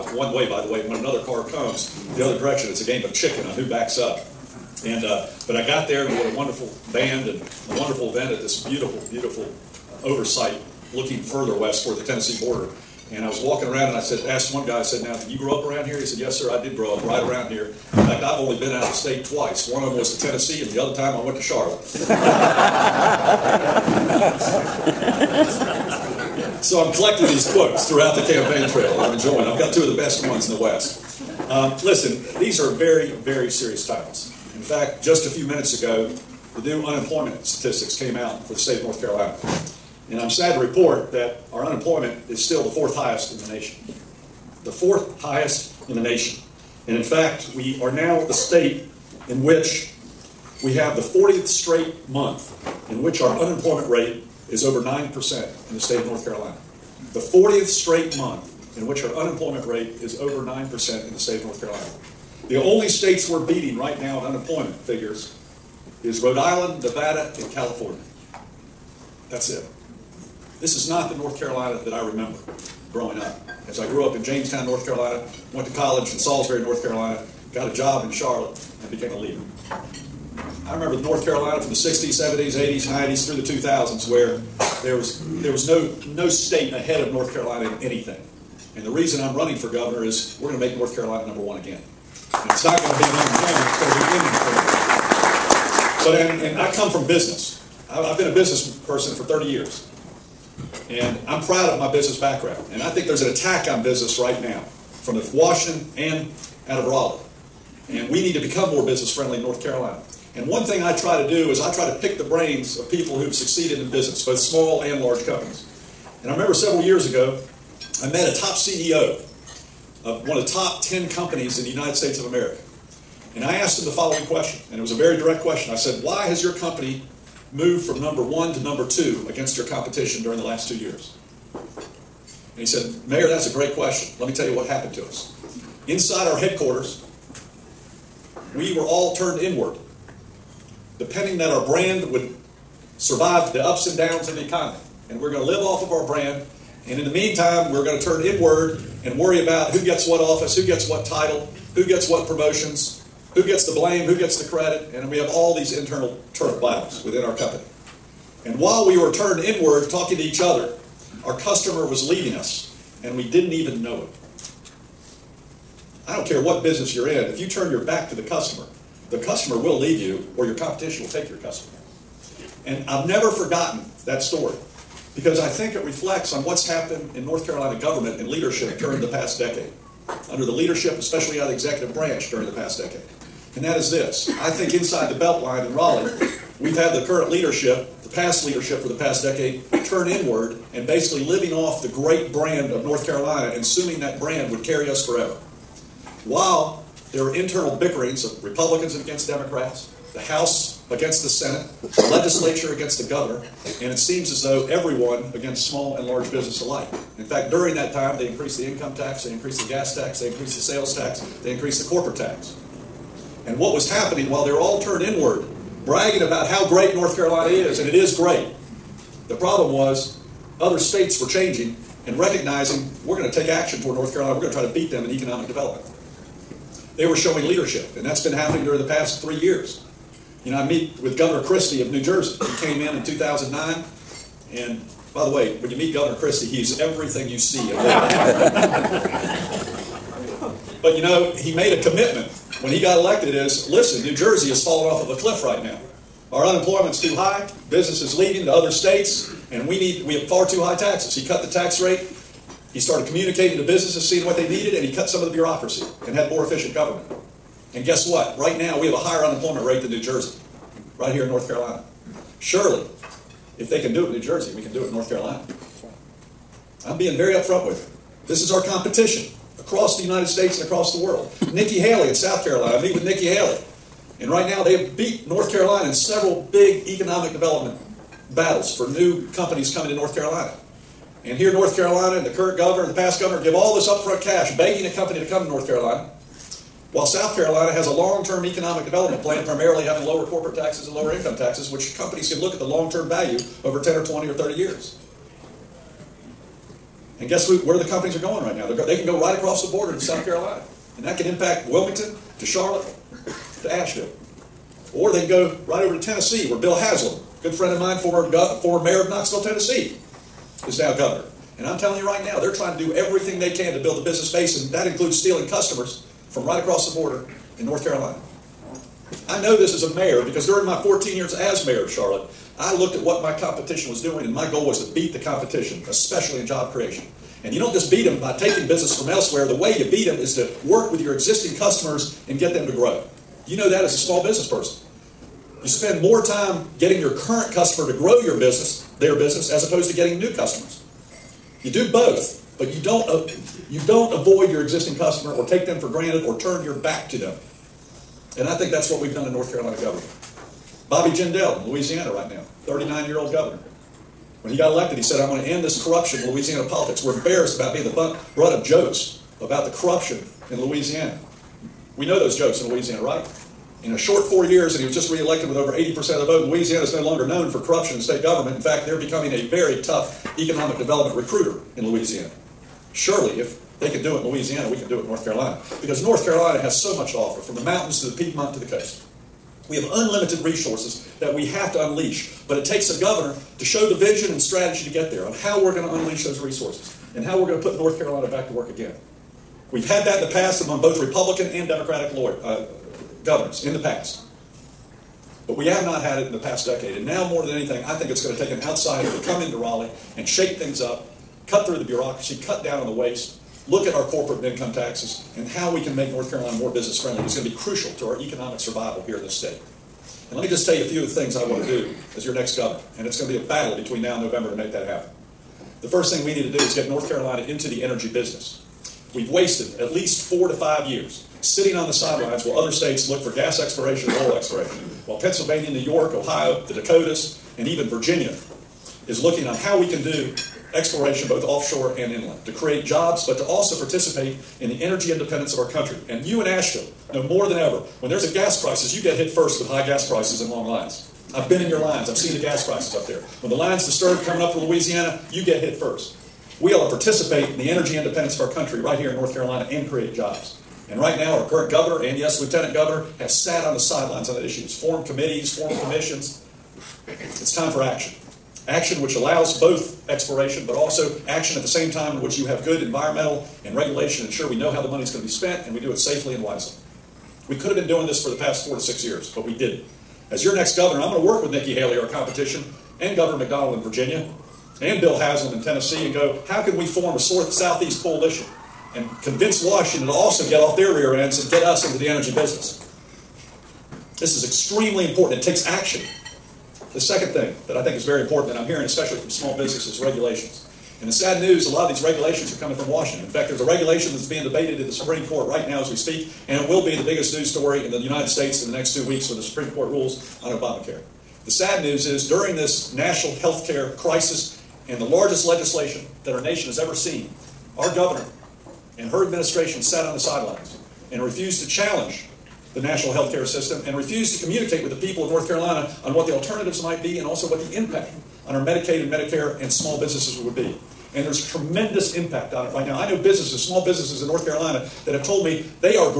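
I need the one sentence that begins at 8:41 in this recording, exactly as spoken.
And there's tremendous impact on it right now.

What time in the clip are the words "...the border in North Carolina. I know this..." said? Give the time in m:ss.
5:16.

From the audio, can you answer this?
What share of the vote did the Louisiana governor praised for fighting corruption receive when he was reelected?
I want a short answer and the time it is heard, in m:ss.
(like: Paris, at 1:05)
over 80%, at 6:05.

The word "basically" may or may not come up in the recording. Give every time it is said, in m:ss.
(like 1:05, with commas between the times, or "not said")
3:10.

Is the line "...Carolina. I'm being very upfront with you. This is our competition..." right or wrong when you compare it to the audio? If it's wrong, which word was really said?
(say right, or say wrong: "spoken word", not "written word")
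right.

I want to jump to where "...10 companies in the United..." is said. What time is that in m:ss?
2:00.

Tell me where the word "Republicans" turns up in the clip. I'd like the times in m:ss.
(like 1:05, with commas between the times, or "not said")
3:18, 6:31.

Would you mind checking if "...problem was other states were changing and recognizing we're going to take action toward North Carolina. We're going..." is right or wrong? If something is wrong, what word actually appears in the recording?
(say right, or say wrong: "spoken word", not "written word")
right.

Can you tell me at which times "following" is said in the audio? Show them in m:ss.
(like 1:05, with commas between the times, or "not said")
2:03.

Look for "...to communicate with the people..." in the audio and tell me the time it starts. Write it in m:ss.
8:34.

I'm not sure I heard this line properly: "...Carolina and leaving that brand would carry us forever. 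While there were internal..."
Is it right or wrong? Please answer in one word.
wrong.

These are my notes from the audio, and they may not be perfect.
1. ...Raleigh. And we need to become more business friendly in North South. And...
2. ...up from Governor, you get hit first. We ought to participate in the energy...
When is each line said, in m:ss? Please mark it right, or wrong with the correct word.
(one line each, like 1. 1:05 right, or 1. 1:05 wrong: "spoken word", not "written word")
1. 1:46 wrong: "Carolina", not "South"
2. 7:24 wrong: "Louisiana", not "Governor".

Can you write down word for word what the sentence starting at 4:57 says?
And guess who, where the companies are going right now?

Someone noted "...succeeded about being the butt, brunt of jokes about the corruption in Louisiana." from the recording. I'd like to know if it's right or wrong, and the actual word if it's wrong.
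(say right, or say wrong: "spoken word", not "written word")
wrong: "embarrassed", not "succeeded".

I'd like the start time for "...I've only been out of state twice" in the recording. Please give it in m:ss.
0:18.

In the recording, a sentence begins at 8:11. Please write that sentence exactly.
And the sad news, a lot of these regulations are coming from Washington.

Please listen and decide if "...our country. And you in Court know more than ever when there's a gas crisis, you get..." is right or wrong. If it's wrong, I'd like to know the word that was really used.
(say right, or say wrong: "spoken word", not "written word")
wrong: "Asheville", not "Court".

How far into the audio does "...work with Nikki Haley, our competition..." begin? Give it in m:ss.
7:51.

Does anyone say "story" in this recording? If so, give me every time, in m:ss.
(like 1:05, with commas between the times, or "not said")
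2:54, 8:17.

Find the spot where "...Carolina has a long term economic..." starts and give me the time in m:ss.
4:47.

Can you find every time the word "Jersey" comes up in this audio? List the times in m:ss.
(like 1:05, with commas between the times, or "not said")
3:52, 4:04, 4:20, 4:24.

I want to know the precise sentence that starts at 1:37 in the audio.
I've been a business person for 30 years.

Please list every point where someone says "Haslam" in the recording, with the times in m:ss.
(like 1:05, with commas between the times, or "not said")
5:06, 7:55.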